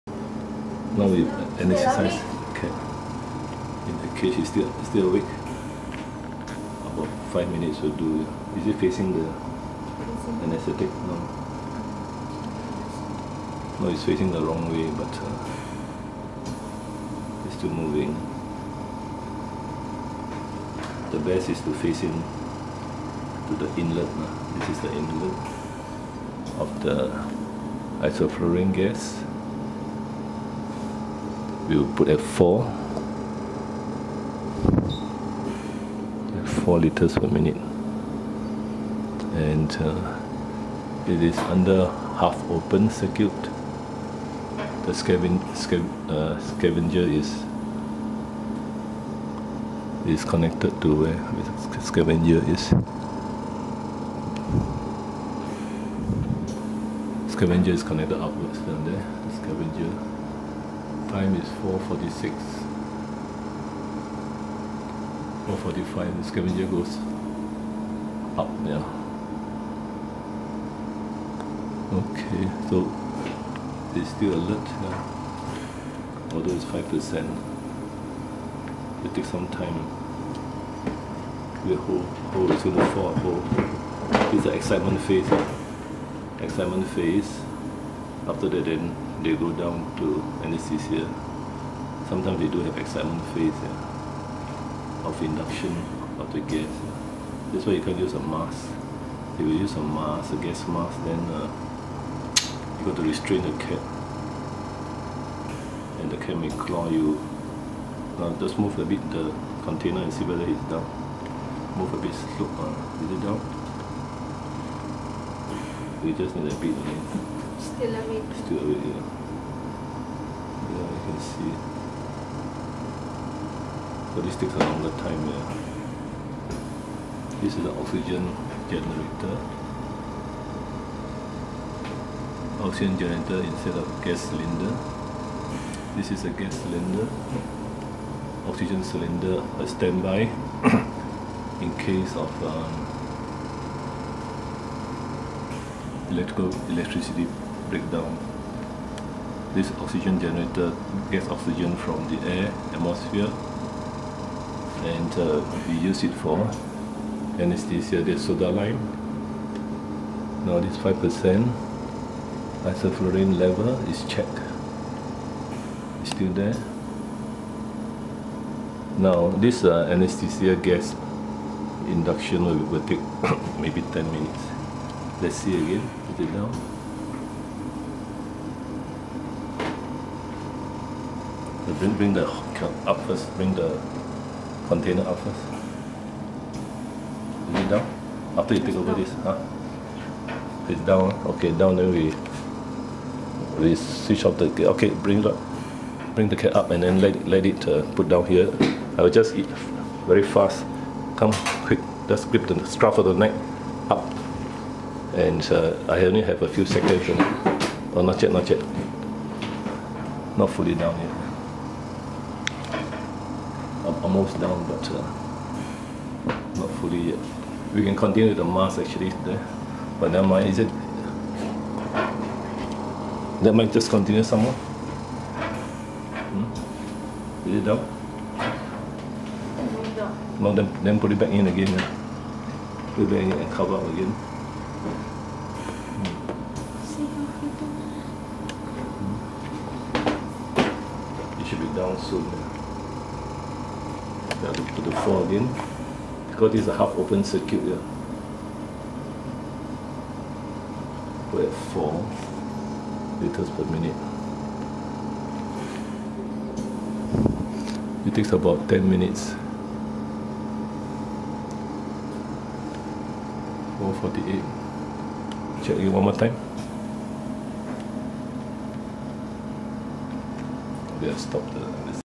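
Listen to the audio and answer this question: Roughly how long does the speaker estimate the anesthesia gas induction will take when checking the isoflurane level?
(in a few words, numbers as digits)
10 minutes.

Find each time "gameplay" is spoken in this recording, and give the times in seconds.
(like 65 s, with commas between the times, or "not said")
not said.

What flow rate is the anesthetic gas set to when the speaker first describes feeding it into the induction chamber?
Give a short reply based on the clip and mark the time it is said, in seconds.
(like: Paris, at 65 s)
4 liters per minute, at 32 s.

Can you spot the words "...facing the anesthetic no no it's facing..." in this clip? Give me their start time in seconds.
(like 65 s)
8 s.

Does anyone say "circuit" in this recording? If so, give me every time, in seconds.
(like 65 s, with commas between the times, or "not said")
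42 s, 247 s.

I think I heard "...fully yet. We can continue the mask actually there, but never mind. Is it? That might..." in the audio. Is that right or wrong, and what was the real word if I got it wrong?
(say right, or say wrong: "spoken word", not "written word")
right.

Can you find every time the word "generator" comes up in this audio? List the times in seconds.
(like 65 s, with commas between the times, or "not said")
128 s, 132 s, 150 s.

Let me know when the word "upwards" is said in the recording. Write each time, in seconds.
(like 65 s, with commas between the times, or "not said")
58 s.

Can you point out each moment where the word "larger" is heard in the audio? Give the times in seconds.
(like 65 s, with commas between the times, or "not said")
not said.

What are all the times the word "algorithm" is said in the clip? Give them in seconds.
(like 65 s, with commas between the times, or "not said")
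not said.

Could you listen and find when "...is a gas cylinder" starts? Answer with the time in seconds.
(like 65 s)
136 s.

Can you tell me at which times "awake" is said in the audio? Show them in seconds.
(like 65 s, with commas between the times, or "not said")
5 s, 117 s.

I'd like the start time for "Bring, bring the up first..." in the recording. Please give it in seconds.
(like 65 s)
181 s.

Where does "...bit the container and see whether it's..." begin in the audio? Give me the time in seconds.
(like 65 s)
108 s.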